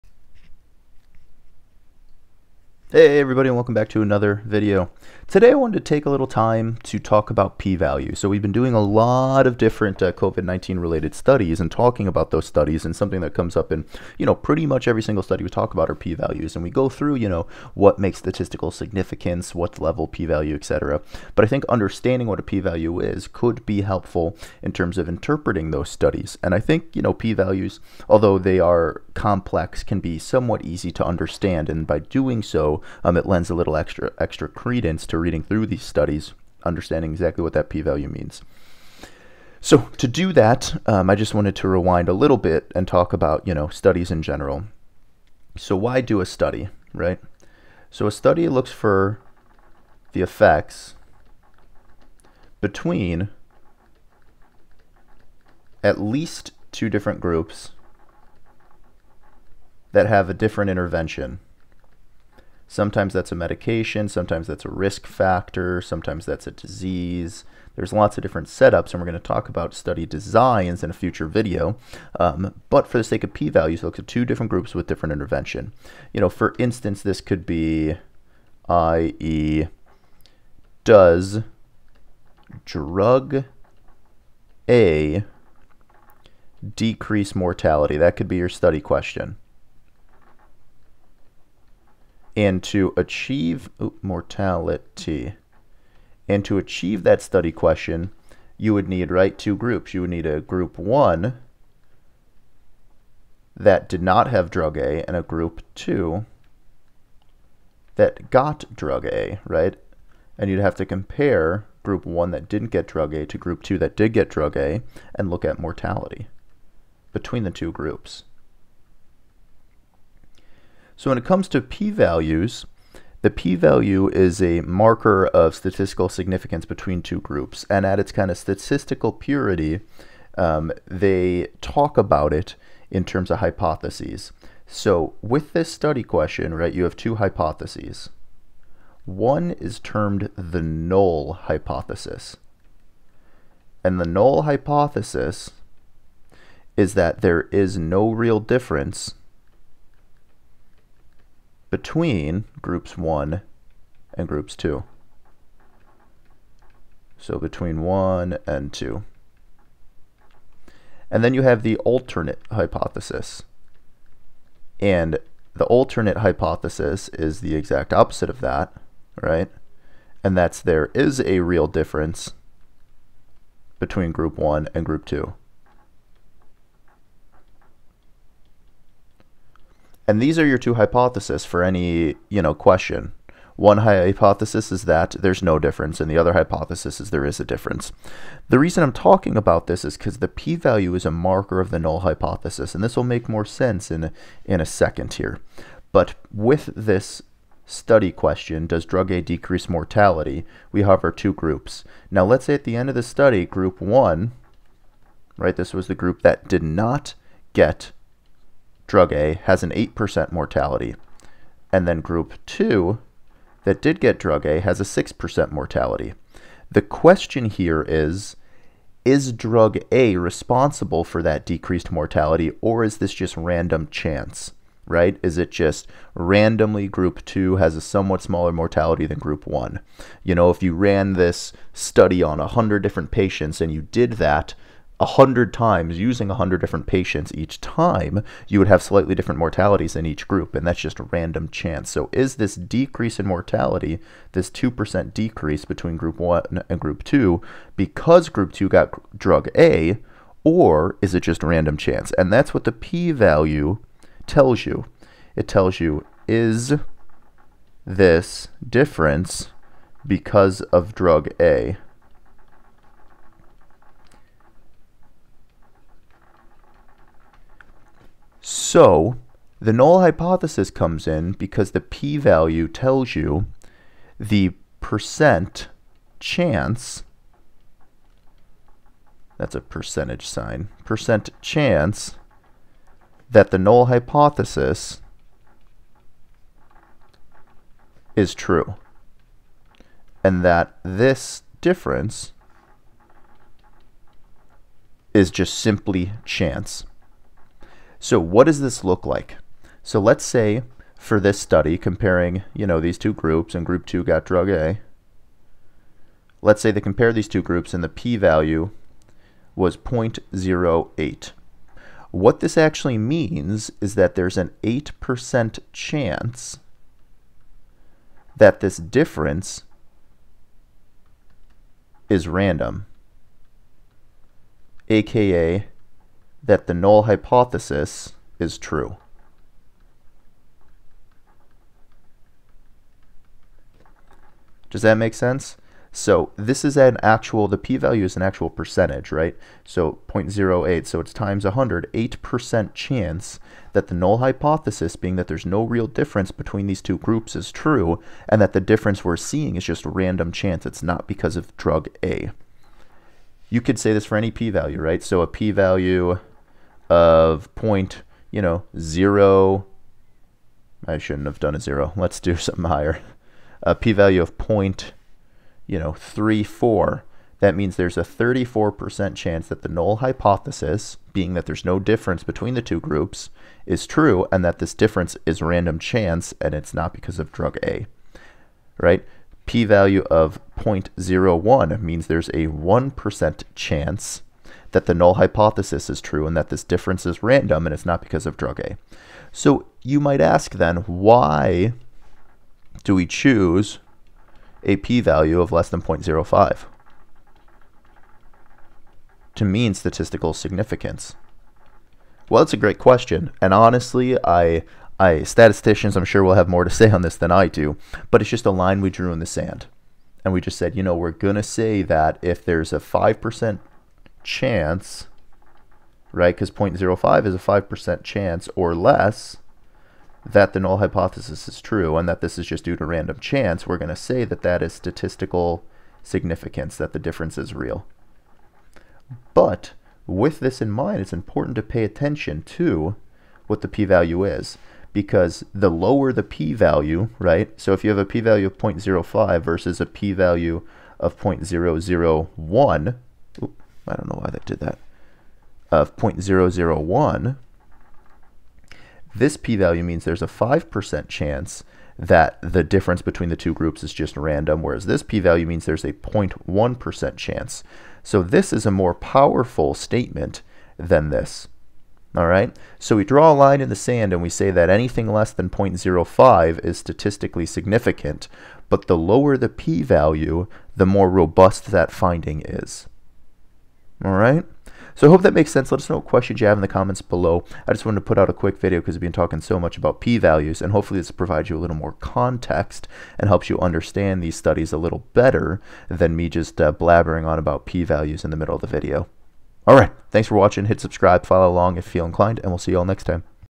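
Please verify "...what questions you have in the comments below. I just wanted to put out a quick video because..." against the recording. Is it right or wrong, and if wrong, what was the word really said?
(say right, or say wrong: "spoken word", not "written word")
right.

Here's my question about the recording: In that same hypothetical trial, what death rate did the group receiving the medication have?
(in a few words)
6%.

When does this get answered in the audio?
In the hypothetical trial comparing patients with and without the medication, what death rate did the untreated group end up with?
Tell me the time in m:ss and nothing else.
3:29.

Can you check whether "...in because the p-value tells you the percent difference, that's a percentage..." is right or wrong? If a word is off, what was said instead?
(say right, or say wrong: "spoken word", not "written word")
wrong: "chance", not "difference".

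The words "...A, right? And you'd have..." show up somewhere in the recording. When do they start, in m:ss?
1:49.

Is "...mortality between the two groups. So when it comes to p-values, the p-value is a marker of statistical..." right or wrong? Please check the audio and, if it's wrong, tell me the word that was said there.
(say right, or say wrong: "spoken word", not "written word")
right.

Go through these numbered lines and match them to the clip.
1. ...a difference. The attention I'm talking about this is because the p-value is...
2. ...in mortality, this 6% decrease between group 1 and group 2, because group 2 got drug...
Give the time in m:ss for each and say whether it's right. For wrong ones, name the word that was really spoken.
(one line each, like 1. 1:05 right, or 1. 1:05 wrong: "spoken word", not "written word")
1. 3:07 wrong: "reason", not "attention"
2. 4:03 wrong: "2", not "6".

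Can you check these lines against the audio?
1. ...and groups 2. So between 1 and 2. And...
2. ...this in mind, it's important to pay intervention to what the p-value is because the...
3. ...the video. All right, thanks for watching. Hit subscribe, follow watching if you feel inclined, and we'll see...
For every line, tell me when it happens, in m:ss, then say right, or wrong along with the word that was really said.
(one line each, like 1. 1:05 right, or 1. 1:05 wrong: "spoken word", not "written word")
1. 2:34 right
2. 7:10 wrong: "attention", not "intervention"
3. 8:08 wrong: "along", not "watching".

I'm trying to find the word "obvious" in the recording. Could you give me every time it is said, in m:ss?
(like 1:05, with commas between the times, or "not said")
not said.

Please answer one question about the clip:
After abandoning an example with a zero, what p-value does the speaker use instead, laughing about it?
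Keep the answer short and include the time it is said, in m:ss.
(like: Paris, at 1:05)
0.34, at 6:04.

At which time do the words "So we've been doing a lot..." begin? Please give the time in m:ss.
0:08.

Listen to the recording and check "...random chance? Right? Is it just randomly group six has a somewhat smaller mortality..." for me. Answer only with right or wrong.
wrong.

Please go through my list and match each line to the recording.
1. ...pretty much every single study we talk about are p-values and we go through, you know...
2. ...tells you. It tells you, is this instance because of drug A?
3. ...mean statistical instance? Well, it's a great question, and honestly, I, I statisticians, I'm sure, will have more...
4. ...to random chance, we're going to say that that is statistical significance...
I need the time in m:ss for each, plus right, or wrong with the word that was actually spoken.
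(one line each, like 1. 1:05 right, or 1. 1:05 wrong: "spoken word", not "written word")
1. 0:14 right
2. 4:14 wrong: "difference", not "instance"
3. 6:39 wrong: "significance", not "instance"
4. 7:02 right.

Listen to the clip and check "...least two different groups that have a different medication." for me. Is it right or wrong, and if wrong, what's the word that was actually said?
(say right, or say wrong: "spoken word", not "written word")
wrong: "intervention", not "medication".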